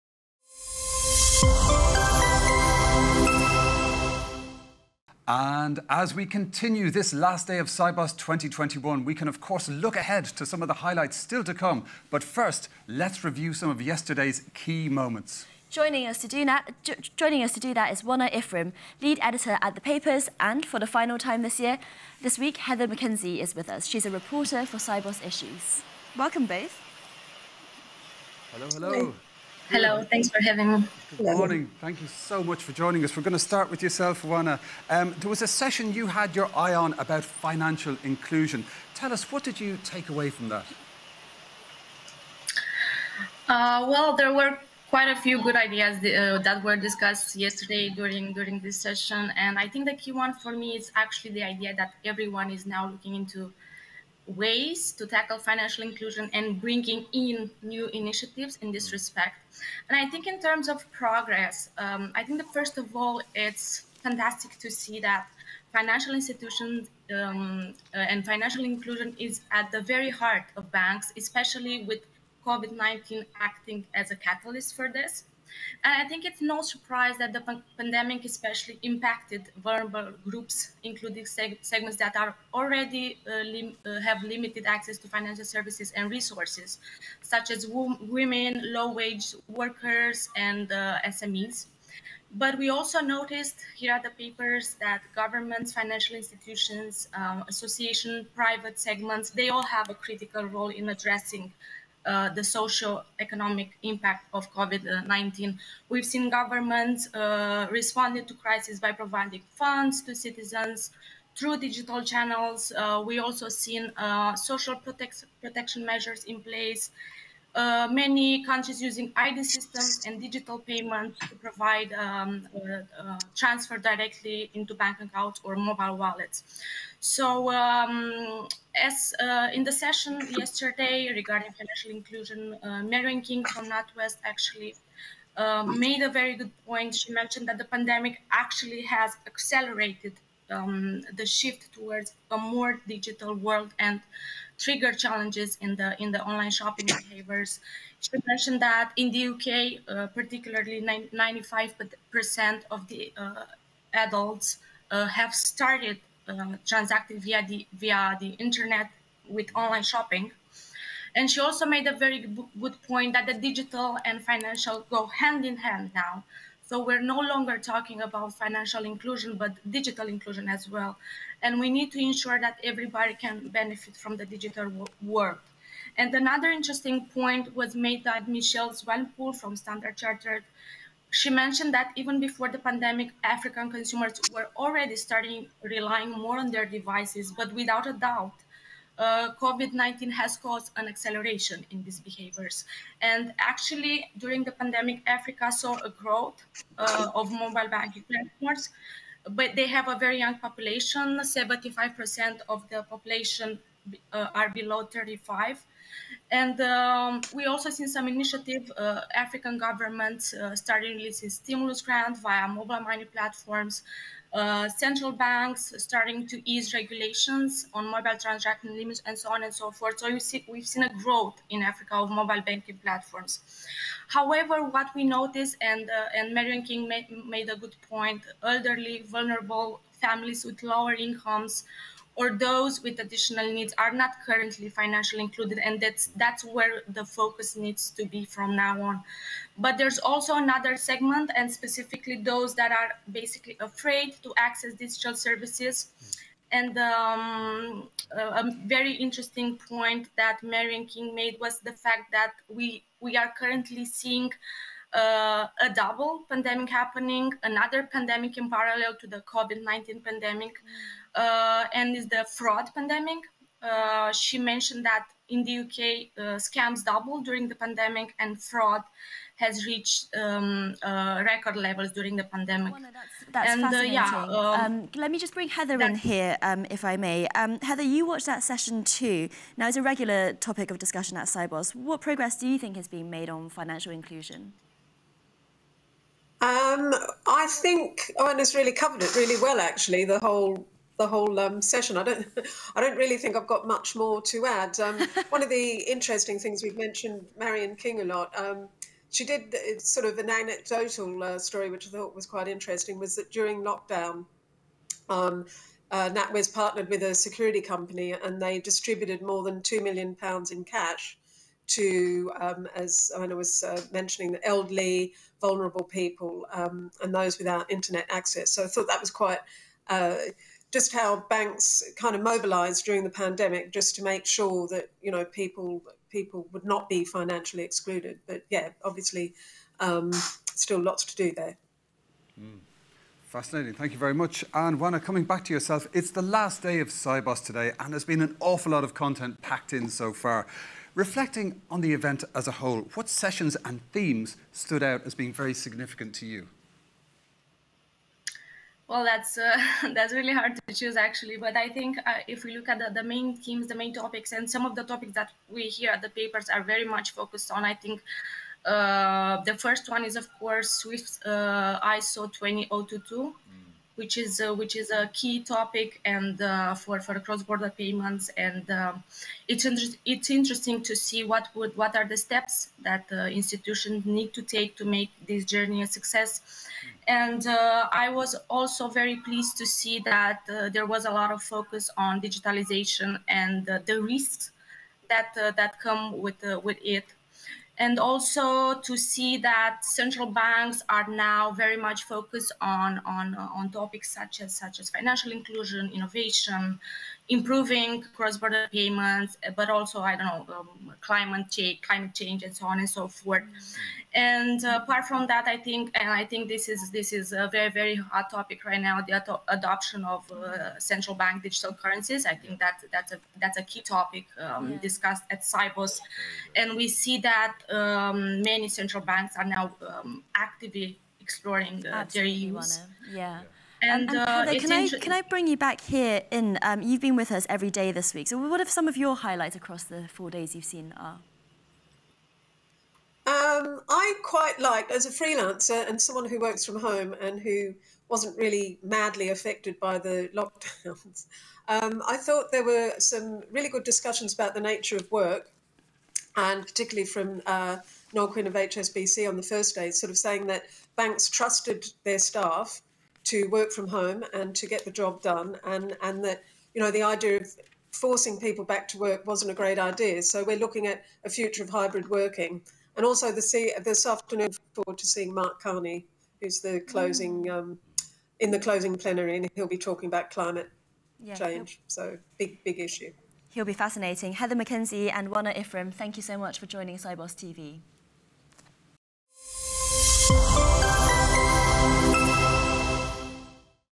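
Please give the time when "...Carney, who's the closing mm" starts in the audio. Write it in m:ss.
7:45.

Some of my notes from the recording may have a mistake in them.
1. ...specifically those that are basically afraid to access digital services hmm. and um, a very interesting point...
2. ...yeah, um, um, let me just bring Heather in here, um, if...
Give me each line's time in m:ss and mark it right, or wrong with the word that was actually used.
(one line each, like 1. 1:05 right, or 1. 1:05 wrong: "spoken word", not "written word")
1. 4:01 right
2. 4:34 right.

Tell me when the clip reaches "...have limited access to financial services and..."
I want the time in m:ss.
1:24.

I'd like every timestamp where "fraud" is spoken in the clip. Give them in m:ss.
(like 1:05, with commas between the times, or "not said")
4:22, 4:28.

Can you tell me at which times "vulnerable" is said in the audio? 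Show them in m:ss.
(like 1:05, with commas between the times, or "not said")
1:19, 3:49, 5:15.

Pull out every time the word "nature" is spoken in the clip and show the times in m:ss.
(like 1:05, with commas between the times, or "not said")
7:24.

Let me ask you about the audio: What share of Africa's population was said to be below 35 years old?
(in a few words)
75%.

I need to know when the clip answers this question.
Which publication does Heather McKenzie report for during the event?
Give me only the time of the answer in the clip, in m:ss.
0:24.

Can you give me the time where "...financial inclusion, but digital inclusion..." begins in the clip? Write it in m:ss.
2:48.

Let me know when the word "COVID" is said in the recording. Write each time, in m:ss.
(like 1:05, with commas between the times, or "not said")
1:12, 1:44, 3:09, 4:19.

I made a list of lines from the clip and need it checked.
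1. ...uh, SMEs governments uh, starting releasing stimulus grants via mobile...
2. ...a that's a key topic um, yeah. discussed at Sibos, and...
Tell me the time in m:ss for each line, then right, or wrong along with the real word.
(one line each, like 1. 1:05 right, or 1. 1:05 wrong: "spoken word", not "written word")
1. 3:28 wrong: "African", not "SMEs"
2. 6:53 right.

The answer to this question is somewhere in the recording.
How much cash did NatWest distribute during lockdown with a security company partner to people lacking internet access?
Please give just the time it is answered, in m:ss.
5:09.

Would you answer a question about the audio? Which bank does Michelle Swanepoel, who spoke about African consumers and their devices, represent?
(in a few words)
Standard Chartered.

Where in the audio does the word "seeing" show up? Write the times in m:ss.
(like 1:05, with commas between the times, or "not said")
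4:13, 7:45.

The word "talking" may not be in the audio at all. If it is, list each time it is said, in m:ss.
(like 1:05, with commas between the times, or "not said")
2:47, 7:49.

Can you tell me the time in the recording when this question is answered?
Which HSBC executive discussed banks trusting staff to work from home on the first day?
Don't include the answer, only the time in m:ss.
7:28.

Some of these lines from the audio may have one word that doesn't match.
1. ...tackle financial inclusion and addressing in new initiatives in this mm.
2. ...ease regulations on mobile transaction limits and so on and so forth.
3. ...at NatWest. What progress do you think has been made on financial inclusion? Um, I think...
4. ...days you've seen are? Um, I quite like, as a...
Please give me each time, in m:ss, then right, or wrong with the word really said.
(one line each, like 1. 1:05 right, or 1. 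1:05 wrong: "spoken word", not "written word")
1. 0:55 wrong: "bringing", not "addressing"
2. 3:36 right
3. 4:41 wrong: "Sibos", not "NatWest"
4. 7:10 right.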